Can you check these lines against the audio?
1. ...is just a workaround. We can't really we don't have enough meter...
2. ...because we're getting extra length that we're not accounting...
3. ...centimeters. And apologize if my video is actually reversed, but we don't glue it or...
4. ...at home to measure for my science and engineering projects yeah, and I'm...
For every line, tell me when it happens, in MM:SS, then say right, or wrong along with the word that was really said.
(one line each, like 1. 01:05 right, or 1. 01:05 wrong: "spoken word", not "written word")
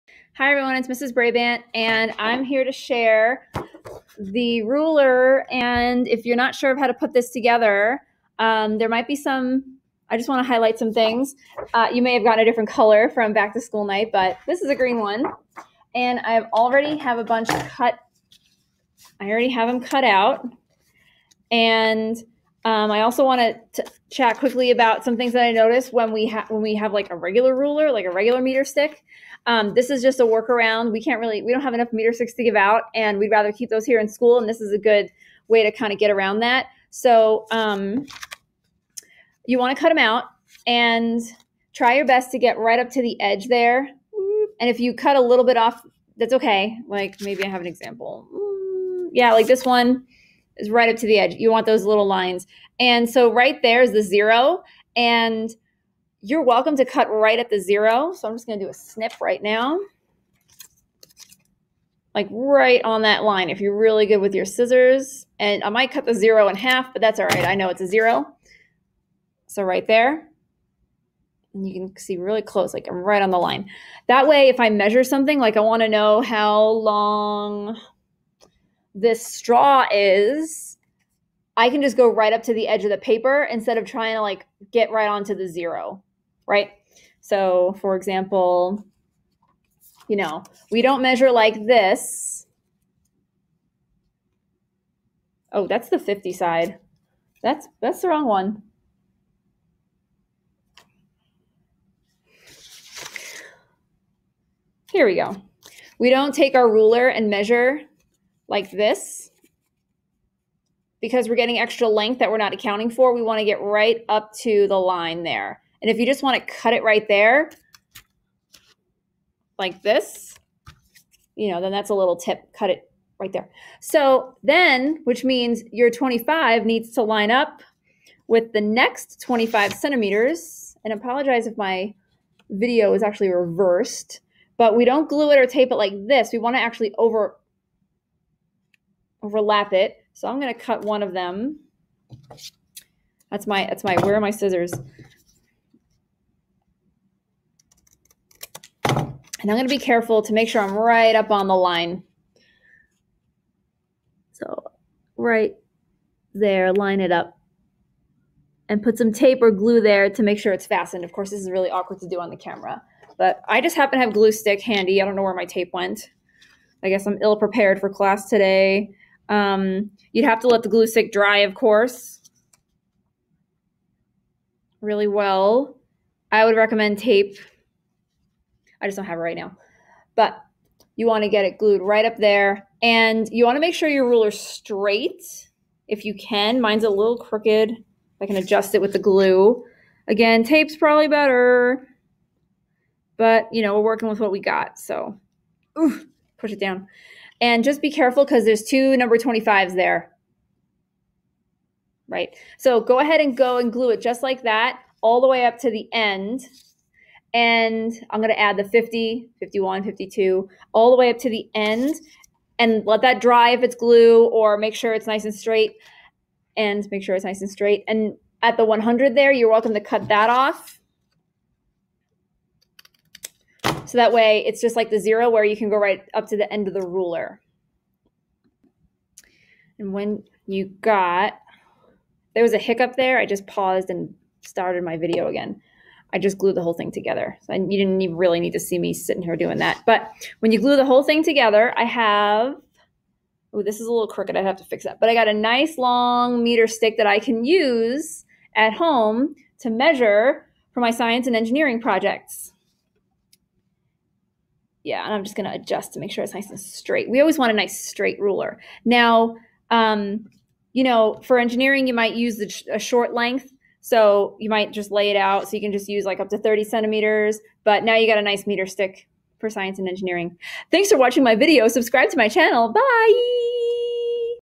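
1. 00:29 right
2. 01:51 right
3. 02:09 right
4. 04:08 right.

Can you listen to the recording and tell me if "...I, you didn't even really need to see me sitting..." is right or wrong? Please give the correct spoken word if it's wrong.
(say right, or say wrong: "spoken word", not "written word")
right.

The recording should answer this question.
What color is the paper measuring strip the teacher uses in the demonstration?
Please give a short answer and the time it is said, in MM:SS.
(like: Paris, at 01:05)
green, at 00:14.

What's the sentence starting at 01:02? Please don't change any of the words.
Like right on that line if you're really good with your scissors.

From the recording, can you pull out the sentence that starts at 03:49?
And when you got, there was a hiccup there.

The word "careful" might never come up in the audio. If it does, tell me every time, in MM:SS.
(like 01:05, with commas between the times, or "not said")
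02:29, 03:17.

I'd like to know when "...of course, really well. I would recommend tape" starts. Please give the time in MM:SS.
02:51.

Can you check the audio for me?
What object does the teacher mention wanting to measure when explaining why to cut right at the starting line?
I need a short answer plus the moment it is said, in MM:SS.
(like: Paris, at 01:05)
straw, at 01:19.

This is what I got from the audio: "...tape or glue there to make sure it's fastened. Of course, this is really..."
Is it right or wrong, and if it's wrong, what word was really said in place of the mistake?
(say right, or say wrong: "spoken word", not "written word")
right.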